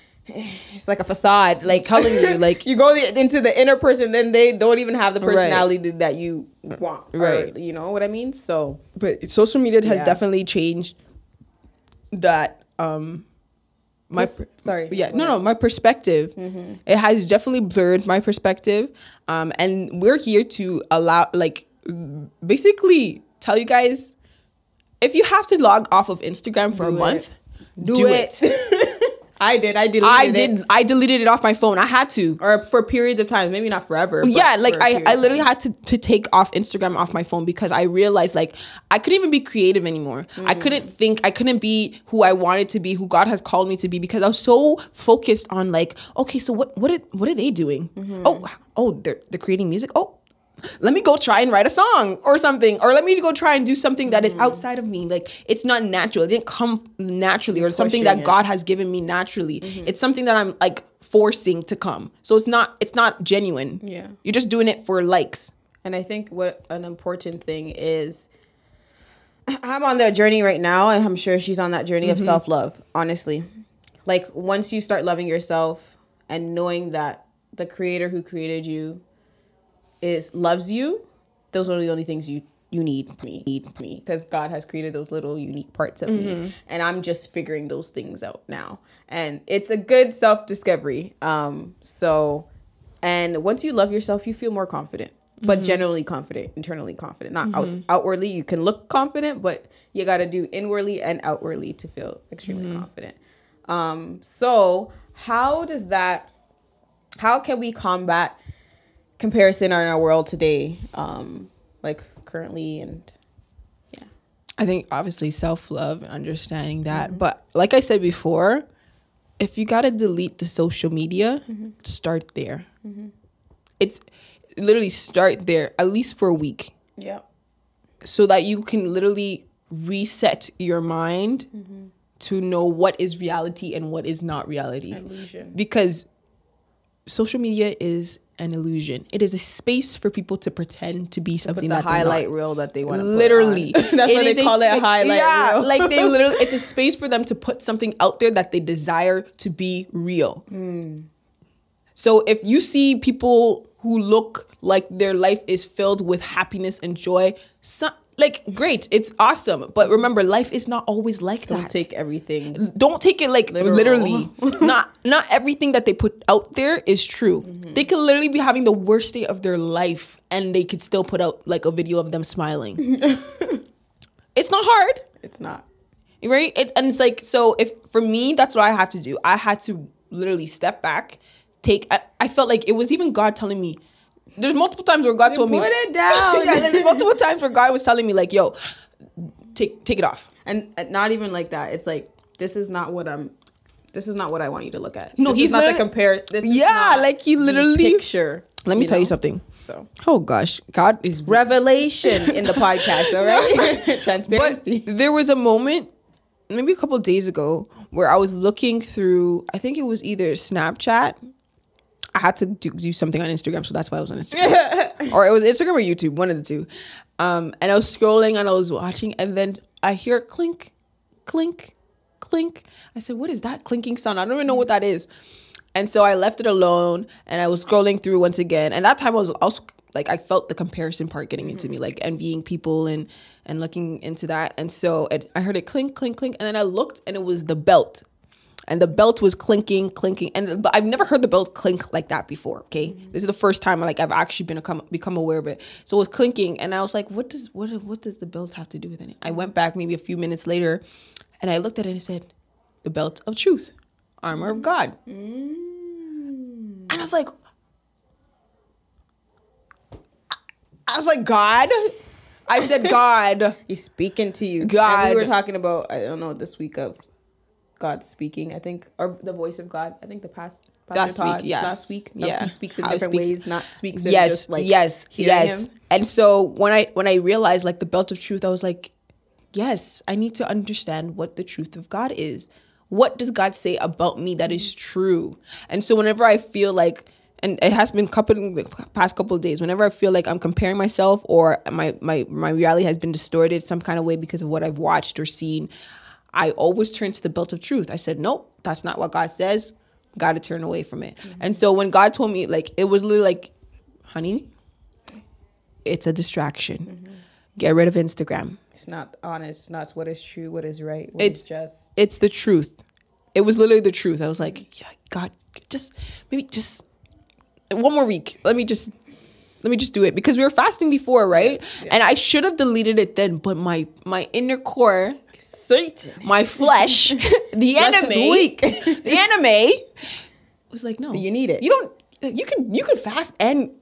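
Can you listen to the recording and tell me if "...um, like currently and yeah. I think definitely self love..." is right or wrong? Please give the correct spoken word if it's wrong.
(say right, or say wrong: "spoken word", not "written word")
wrong: "obviously", not "definitely".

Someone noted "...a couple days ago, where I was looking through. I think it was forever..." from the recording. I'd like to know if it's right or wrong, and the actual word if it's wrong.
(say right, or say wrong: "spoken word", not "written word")
wrong: "either", not "forever".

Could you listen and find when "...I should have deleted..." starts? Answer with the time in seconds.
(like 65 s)
322 s.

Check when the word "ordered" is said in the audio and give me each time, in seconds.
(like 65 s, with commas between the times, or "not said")
not said.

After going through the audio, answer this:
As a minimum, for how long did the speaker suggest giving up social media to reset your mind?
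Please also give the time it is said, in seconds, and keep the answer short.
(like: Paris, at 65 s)
a week, at 125 s.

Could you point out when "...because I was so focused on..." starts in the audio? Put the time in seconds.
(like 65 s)
43 s.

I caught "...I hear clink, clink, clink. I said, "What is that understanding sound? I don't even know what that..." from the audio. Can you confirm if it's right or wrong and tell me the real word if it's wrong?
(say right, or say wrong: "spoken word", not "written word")
wrong: "clinking", not "understanding".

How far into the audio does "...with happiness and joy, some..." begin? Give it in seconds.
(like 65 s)
156 s.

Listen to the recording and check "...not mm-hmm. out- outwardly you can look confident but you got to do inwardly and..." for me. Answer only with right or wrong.
right.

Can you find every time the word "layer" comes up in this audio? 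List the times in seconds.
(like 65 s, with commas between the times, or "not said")
not said.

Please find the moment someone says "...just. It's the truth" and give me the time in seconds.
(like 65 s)
311 s.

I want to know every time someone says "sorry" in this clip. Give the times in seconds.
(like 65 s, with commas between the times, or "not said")
14 s.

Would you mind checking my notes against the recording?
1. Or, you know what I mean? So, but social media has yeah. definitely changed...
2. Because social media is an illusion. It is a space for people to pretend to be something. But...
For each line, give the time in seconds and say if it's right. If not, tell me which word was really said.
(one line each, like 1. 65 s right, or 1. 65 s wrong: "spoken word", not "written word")
1. 7 s right
2. 135 s right.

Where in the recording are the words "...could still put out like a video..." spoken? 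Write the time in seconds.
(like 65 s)
170 s.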